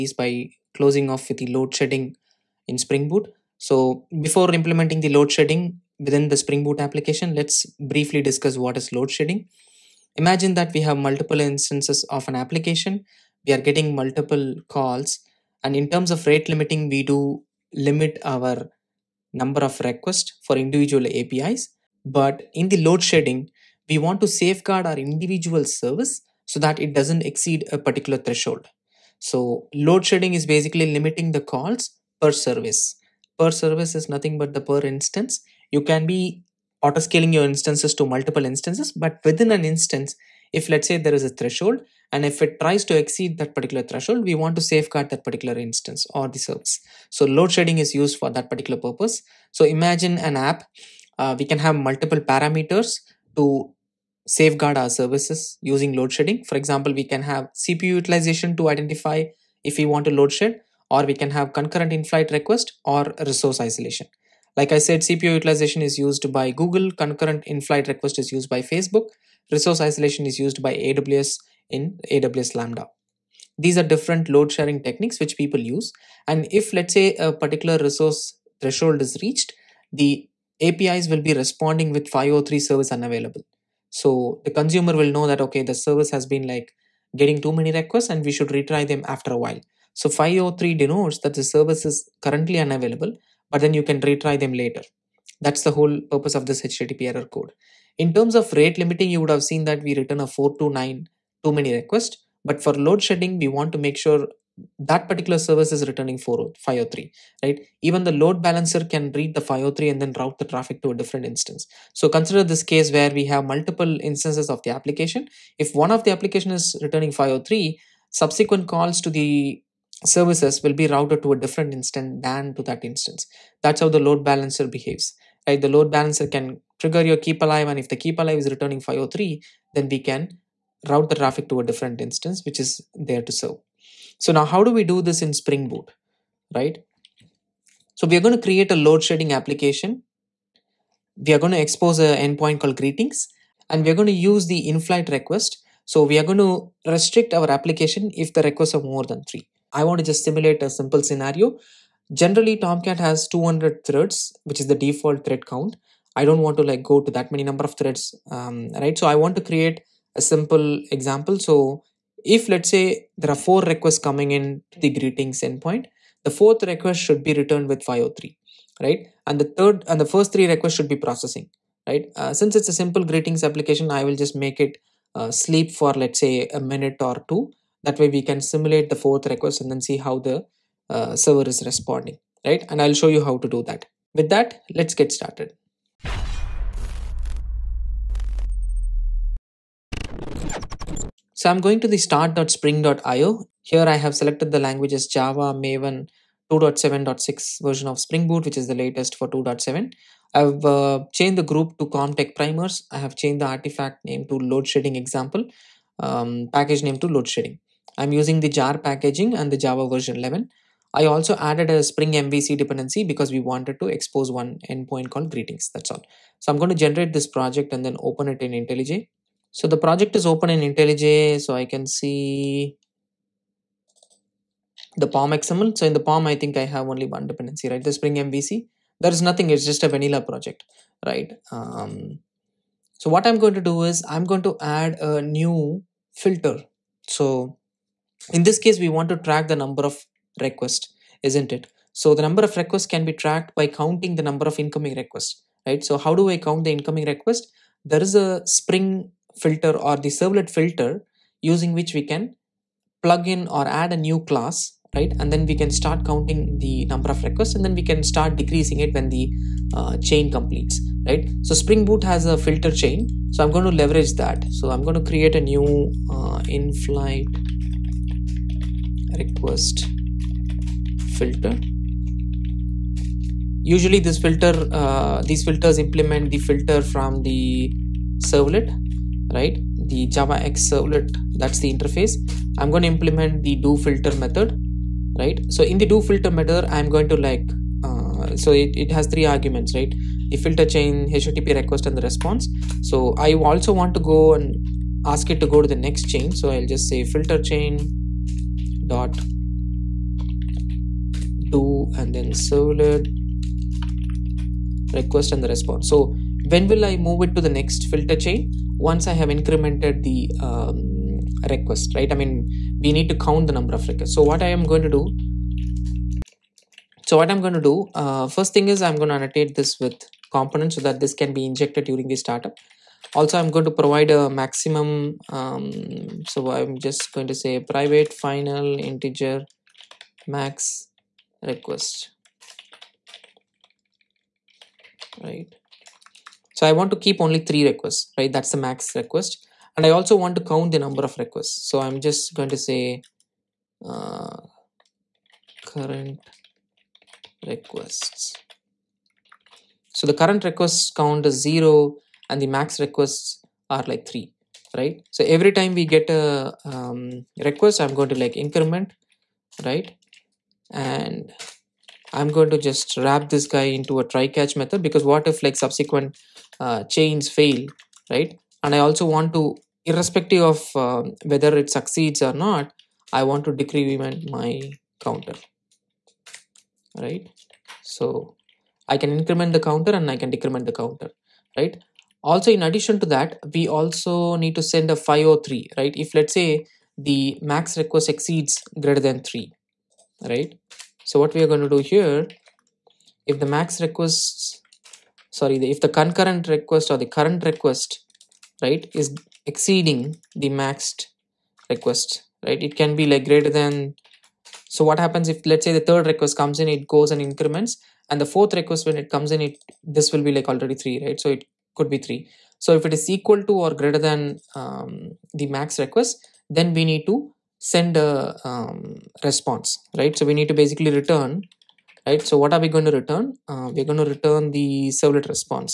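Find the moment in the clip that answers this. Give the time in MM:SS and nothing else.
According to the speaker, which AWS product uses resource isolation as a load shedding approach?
01:12.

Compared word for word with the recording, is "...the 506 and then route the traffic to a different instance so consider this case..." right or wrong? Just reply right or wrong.
wrong.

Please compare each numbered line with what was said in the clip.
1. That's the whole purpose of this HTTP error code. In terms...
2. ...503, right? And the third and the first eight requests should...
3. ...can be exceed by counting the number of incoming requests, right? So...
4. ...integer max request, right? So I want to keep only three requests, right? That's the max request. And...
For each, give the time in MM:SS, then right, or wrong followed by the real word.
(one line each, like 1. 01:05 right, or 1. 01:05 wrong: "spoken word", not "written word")
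1. 01:35 right
2. 02:47 wrong: "three", not "eight"
3. 04:02 wrong: "tracked", not "exceed"
4. 05:28 right.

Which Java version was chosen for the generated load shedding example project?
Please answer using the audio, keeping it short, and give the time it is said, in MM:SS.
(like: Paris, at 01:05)
Java 11, at 03:29.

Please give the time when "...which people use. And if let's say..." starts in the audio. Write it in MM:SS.
01:15.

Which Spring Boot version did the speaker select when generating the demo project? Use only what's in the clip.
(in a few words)
2.7.6.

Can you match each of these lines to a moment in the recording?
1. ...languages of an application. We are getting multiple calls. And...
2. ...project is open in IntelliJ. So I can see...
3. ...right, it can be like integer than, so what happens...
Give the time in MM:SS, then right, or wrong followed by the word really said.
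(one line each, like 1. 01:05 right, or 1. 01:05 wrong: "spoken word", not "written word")
1. 00:11 wrong: "instances", not "languages"
2. 03:39 right
3. 06:42 wrong: "greater", not "integer".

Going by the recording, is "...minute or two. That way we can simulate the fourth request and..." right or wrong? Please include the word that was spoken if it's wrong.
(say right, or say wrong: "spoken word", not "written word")
right.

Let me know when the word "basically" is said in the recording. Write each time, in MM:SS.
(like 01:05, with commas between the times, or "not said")
00:30, 07:00.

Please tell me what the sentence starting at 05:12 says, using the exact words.
I mean, we need to count the number of requests.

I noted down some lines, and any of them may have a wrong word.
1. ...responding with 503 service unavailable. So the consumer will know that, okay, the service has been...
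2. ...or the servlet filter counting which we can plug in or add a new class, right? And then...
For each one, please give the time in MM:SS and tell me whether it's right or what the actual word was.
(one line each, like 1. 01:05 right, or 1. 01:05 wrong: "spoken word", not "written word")
1. 01:21 right
2. 04:09 wrong: "using", not "counting".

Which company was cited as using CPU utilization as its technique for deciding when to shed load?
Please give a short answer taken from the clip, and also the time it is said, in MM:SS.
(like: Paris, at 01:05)
Google, at 01:06.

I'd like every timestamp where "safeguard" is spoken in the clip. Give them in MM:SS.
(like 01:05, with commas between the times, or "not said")
00:24, 00:44, 00:54.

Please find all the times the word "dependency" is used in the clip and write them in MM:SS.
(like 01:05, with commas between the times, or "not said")
03:32, 03:47.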